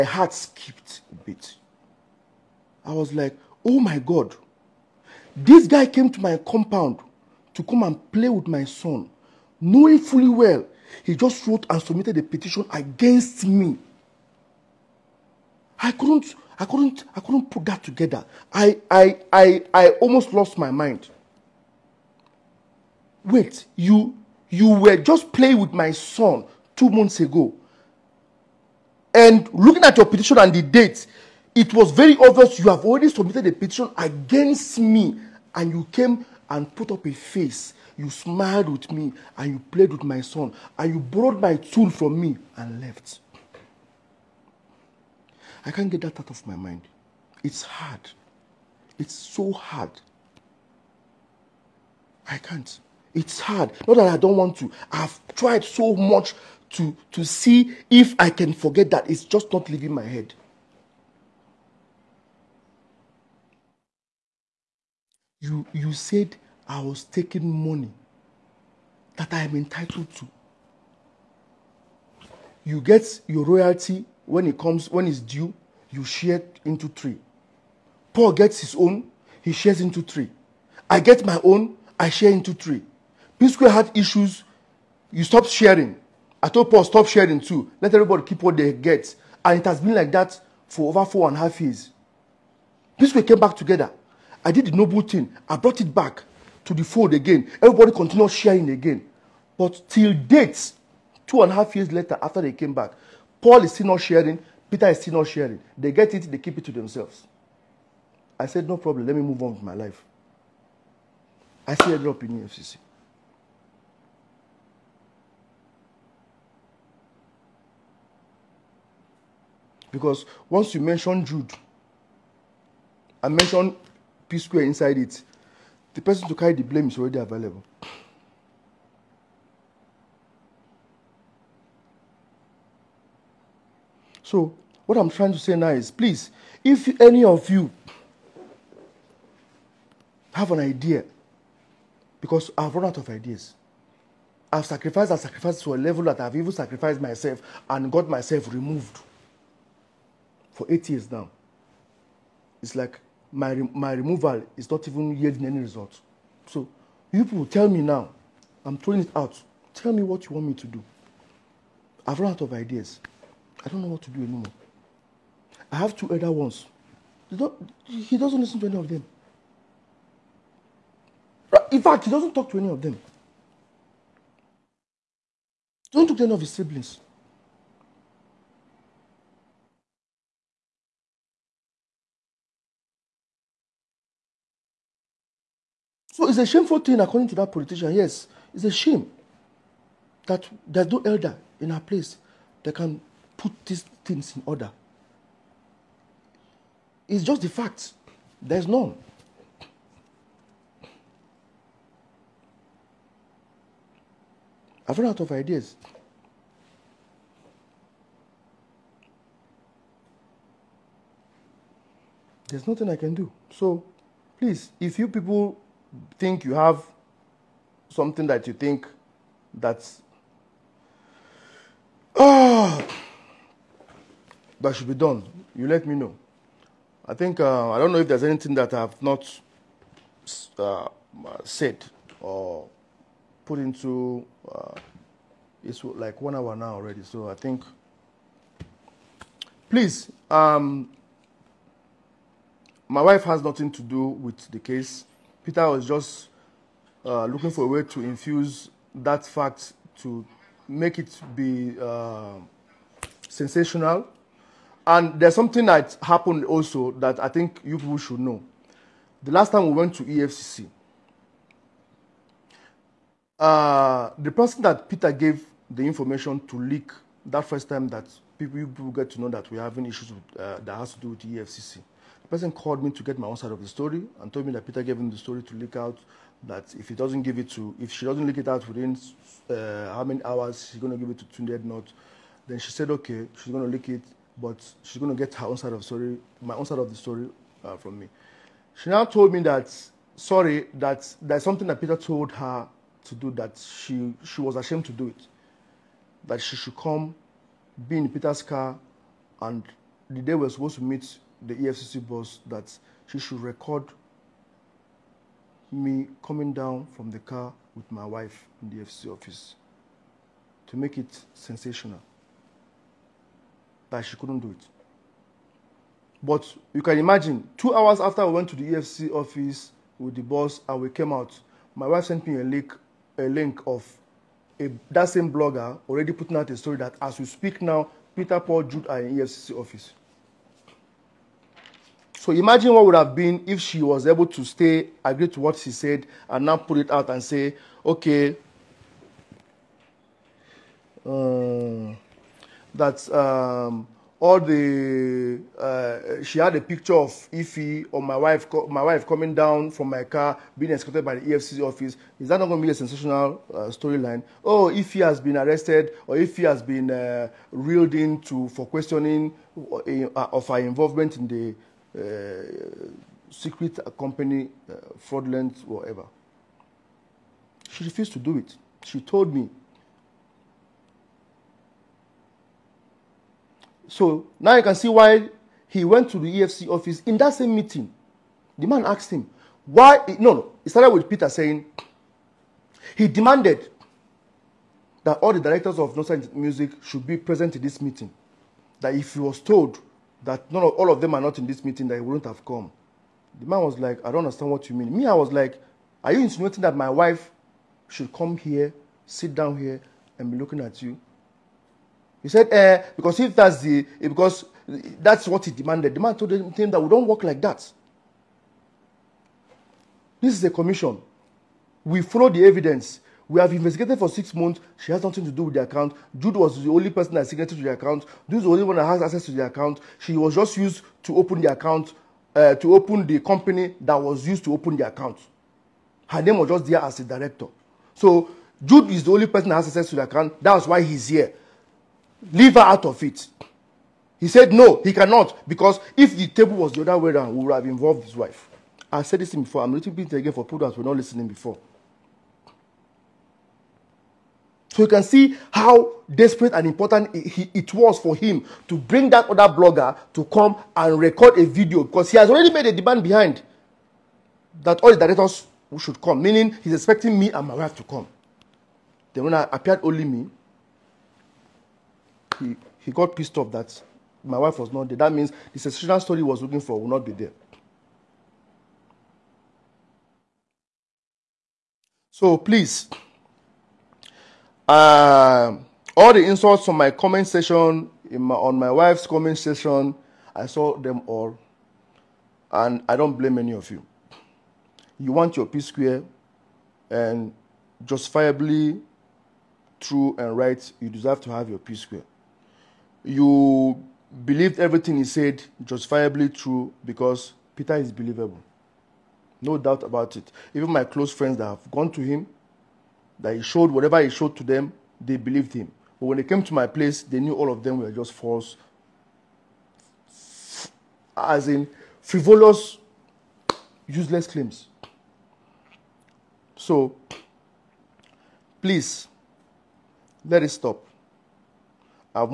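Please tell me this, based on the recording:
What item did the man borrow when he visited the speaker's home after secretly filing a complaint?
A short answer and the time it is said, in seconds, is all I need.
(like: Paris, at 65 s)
tool, at 41 s.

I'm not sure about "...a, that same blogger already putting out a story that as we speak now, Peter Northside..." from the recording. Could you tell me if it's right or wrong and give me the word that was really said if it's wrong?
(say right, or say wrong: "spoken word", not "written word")
wrong: "Paul", not "Northside".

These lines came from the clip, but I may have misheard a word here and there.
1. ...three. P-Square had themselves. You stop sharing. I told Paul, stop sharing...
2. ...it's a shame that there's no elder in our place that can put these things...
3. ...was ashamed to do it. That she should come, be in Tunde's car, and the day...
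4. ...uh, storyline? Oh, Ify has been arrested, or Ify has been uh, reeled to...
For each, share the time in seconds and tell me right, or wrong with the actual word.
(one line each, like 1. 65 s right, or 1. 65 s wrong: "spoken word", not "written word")
1. 82 s wrong: "issues", not "themselves"
2. 188 s right
3. 294 s wrong: "Peter", not "Tunde"
4. 353 s right.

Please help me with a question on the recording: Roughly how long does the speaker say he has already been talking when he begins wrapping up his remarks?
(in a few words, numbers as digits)
1 hour.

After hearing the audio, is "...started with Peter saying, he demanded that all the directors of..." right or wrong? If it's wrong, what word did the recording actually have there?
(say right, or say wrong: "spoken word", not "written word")
right.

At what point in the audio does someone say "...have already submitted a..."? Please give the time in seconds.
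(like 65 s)
32 s.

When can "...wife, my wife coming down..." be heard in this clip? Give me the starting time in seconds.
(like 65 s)
348 s.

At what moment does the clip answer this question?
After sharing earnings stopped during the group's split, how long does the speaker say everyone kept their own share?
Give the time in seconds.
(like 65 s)
90 s.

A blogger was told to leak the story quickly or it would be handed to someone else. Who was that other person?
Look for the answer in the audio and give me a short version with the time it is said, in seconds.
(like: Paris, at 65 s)
Tunde Ednut, at 281 s.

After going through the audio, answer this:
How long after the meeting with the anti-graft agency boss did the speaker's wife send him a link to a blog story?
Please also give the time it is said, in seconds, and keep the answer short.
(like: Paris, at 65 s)
2 hours, at 317 s.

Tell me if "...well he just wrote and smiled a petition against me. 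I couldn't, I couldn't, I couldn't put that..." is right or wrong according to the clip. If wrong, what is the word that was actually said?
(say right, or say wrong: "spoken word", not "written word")
wrong: "submitted", not "smiled".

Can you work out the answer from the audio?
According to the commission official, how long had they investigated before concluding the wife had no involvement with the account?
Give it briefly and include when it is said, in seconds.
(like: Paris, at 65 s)
6 months, at 414 s.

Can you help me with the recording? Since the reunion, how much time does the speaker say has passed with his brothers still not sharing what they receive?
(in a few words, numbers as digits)
2 and a half years.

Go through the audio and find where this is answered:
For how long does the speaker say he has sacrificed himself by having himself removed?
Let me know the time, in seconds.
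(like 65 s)
150 s.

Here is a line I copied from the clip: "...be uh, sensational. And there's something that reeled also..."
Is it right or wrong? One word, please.
wrong.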